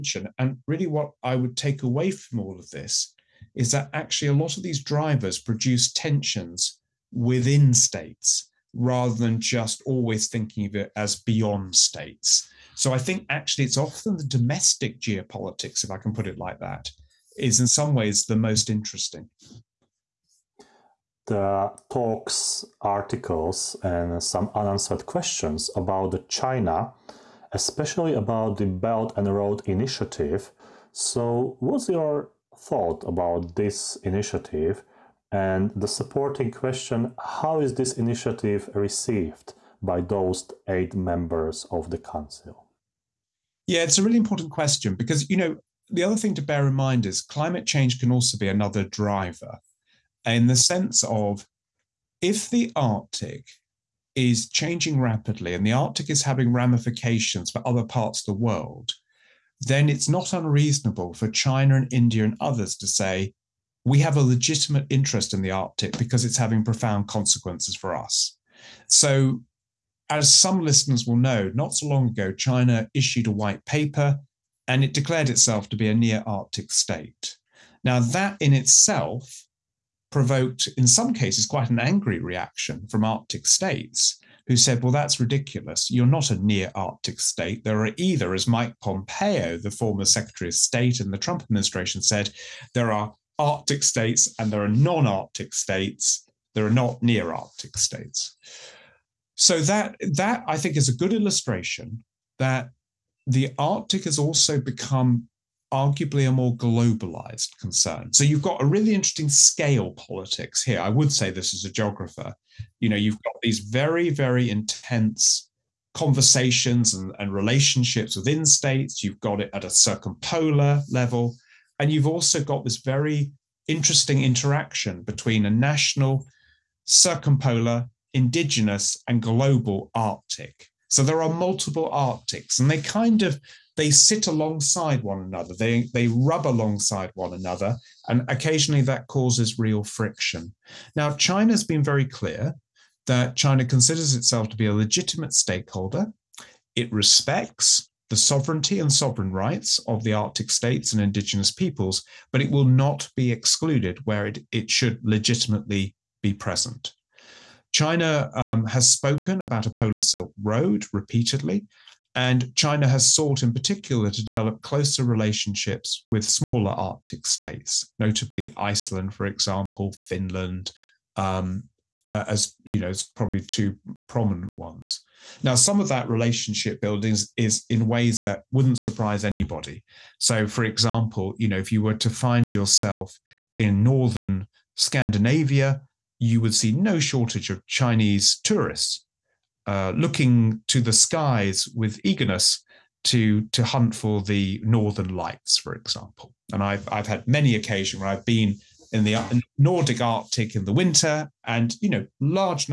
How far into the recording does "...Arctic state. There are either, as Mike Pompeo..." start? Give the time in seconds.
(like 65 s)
86 s.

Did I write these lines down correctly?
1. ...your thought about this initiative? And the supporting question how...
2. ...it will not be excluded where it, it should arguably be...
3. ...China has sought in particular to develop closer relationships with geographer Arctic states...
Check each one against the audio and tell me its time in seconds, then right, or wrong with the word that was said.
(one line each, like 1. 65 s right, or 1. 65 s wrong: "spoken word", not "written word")
1. 31 s right
2. 152 s wrong: "legitimately", not "arguably"
3. 162 s wrong: "smaller", not "geographer".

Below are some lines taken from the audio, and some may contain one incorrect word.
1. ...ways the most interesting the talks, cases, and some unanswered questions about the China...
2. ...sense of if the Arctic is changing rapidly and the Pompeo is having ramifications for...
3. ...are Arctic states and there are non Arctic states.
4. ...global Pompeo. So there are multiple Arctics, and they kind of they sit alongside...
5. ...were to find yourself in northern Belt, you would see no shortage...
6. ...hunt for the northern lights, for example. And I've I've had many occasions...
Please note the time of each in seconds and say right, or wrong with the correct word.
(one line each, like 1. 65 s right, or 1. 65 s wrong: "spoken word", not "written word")
1. 17 s wrong: "articles", not "cases"
2. 50 s wrong: "Arctic", not "Pompeo"
3. 92 s right
4. 129 s wrong: "Arctic", not "Pompeo"
5. 181 s wrong: "Scandinavia", not "Belt"
6. 193 s right.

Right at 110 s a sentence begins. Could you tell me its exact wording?
I would say this as a geographer.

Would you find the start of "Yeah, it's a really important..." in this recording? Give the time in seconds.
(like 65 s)
43 s.